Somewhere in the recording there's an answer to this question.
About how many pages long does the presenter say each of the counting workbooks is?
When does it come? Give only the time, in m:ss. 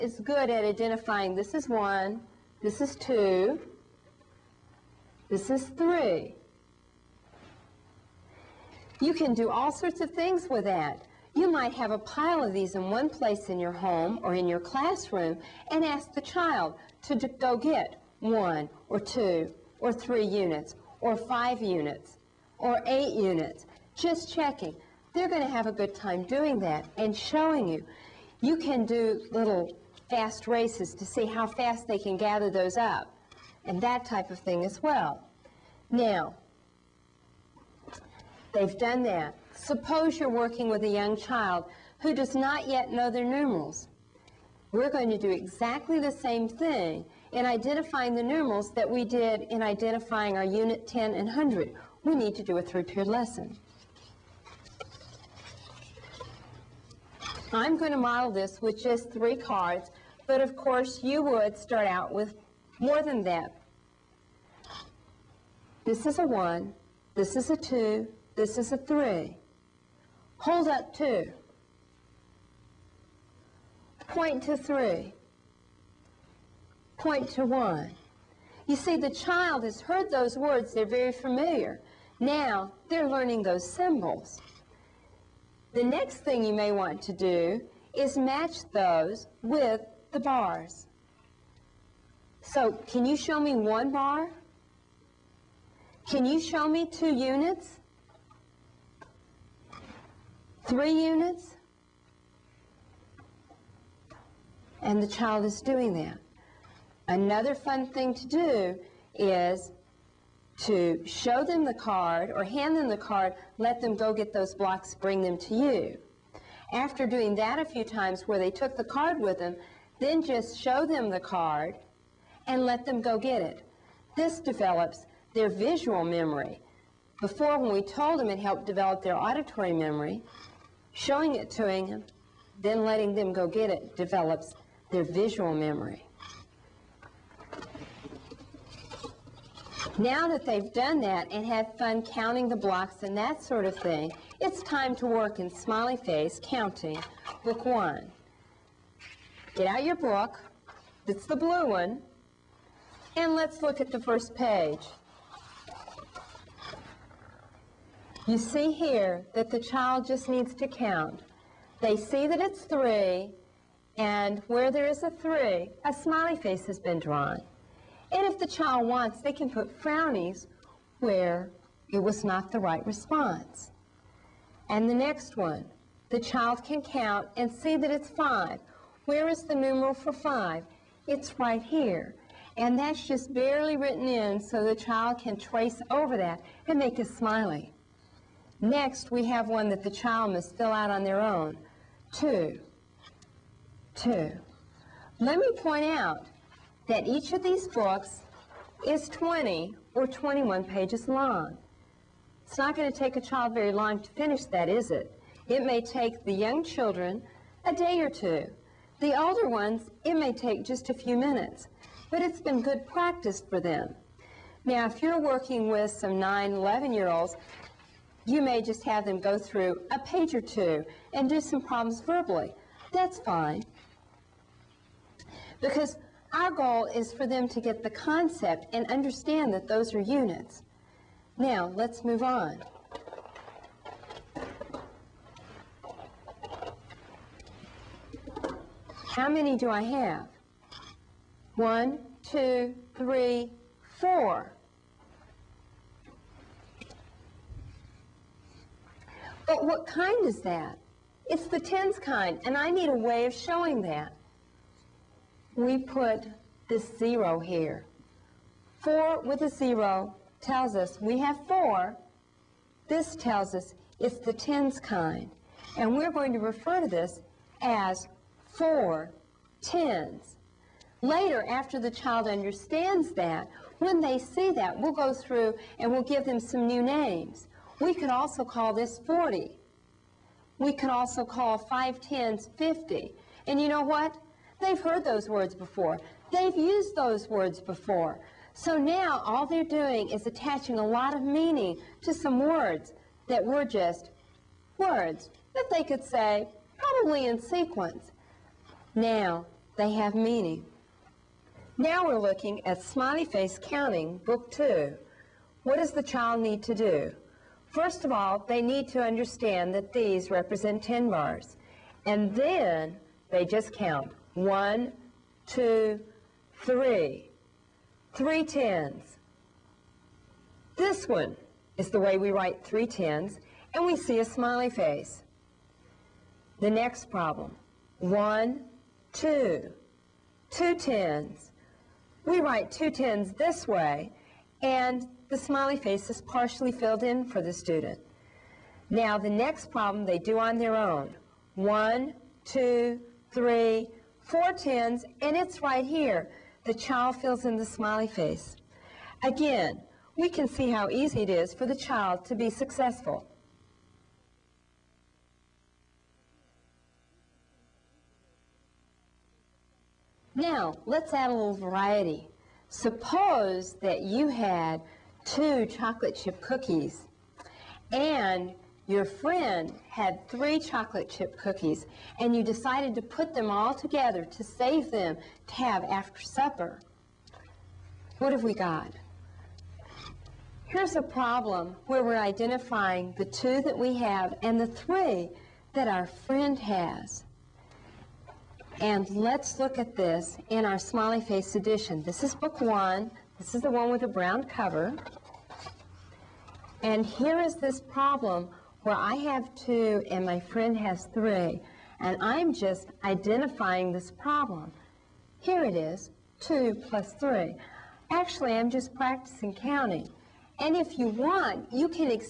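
3:19.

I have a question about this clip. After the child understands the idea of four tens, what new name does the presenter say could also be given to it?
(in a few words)
40.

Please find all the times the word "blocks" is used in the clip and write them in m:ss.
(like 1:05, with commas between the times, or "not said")
1:54, 2:22.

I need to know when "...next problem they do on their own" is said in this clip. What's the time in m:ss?
5:39.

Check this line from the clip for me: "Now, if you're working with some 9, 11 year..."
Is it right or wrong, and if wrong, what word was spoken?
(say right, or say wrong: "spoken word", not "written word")
right.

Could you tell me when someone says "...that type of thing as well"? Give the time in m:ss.
0:33.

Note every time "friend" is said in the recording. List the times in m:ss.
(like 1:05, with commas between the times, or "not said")
6:09, 6:26, 6:40.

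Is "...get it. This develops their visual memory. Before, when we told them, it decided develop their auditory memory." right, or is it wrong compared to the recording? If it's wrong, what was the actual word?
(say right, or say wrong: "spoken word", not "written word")
wrong: "helped", not "decided".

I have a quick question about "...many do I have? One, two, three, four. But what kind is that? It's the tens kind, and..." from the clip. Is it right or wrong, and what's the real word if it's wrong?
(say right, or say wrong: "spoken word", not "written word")
right.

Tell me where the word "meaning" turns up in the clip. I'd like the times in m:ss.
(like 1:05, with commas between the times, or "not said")
4:51, 5:00.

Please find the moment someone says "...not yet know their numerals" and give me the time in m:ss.
0:42.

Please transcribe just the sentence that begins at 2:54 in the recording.
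And the next one, the child can count and see that it's five.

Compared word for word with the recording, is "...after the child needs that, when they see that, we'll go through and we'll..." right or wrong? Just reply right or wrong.
wrong.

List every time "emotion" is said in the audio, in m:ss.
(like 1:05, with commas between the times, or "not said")
not said.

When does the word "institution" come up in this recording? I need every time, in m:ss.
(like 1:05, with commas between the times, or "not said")
not said.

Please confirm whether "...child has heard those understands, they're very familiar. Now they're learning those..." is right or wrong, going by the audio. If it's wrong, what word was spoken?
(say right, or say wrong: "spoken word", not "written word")
wrong: "words", not "understands".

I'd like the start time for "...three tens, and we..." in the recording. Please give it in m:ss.
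5:22.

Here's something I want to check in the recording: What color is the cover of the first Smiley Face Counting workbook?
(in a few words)
blue.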